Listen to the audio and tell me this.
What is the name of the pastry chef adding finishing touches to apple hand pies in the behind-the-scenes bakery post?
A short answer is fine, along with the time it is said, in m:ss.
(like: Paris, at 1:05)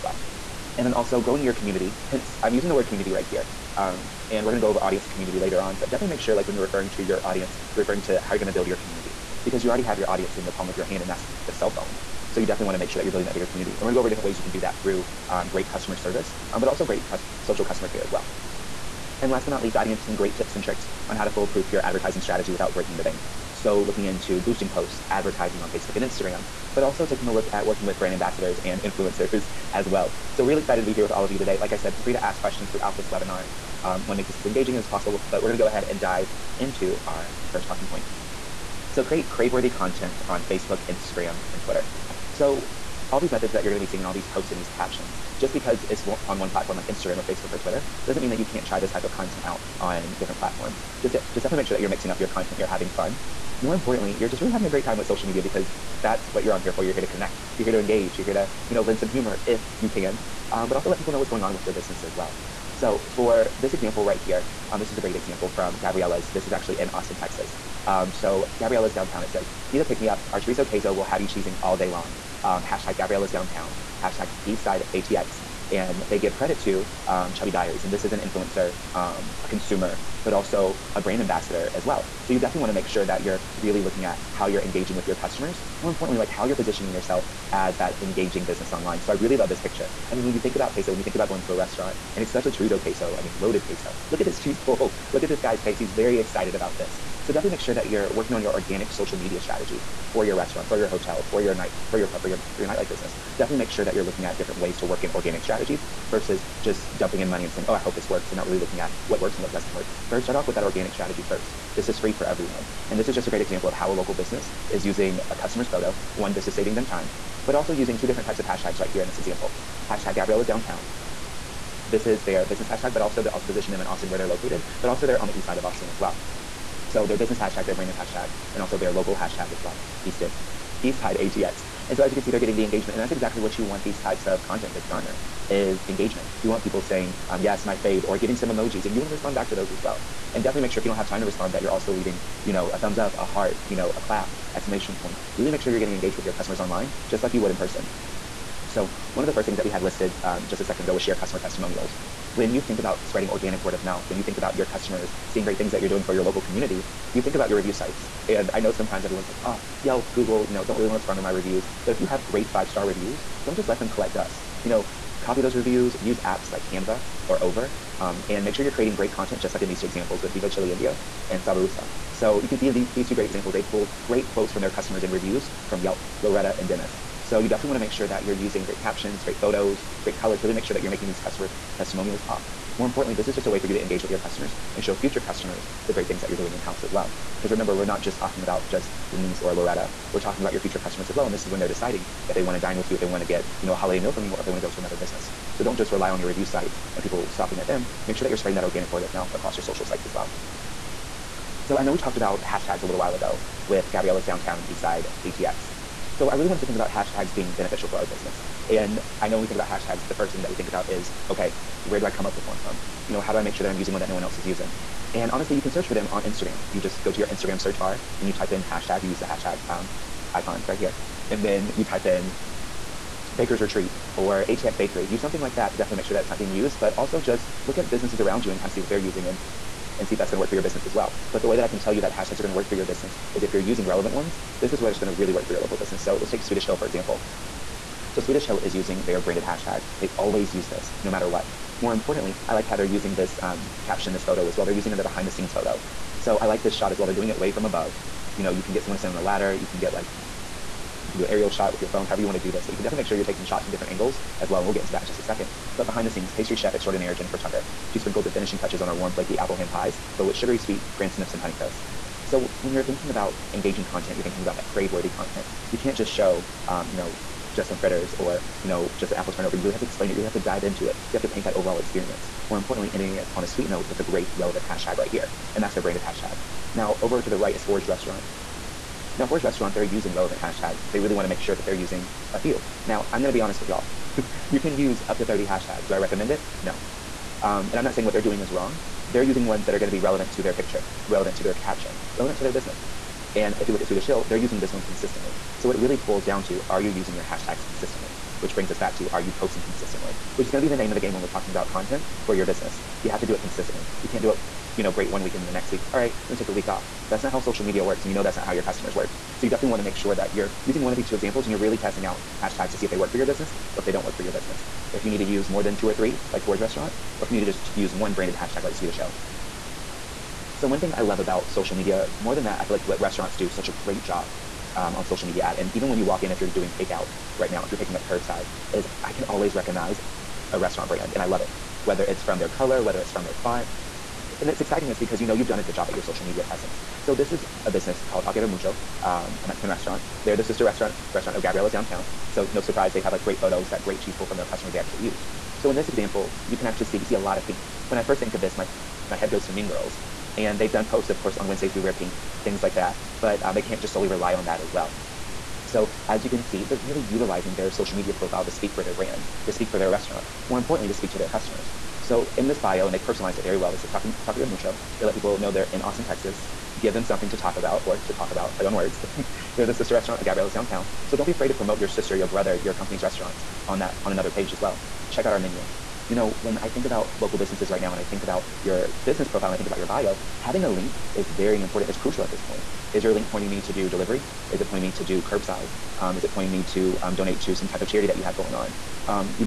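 Jennifer Tucker, at 4:17.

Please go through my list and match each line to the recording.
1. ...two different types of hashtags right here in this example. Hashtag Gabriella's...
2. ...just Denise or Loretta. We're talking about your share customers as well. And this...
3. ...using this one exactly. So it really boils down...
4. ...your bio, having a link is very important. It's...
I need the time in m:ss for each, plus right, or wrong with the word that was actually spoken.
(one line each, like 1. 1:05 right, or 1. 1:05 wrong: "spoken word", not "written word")
1. 1:57 right
2. 3:08 wrong: "future", not "share"
3. 4:54 wrong: "consistently", not "exactly"
4. 6:19 right.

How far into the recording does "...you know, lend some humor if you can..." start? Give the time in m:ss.
0:58.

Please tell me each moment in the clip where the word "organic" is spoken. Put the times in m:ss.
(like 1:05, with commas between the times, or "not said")
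1:38, 1:45, 1:50, 2:33, 3:18.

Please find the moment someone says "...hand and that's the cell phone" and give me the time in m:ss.
0:10.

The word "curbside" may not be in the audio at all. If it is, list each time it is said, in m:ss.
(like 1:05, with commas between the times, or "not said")
5:28, 6:25.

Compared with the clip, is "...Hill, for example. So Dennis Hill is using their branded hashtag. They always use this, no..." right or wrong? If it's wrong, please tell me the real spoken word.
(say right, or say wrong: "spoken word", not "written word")
wrong: "Swedish", not "Dennis".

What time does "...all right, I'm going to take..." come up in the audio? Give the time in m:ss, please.
5:05.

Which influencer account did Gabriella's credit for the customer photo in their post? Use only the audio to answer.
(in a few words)
Chubby Diaries.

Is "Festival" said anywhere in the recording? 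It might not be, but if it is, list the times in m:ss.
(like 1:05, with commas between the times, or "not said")
not said.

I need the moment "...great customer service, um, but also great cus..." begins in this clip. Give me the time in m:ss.
0:15.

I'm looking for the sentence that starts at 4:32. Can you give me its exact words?
More importantly, ending it on a sweet note with a great relevant hashtag right here.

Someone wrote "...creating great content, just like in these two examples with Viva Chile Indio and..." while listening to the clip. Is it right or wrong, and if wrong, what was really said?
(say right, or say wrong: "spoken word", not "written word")
right.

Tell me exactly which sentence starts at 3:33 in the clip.
You know, how do I make sure that I'm using one that no one else is using?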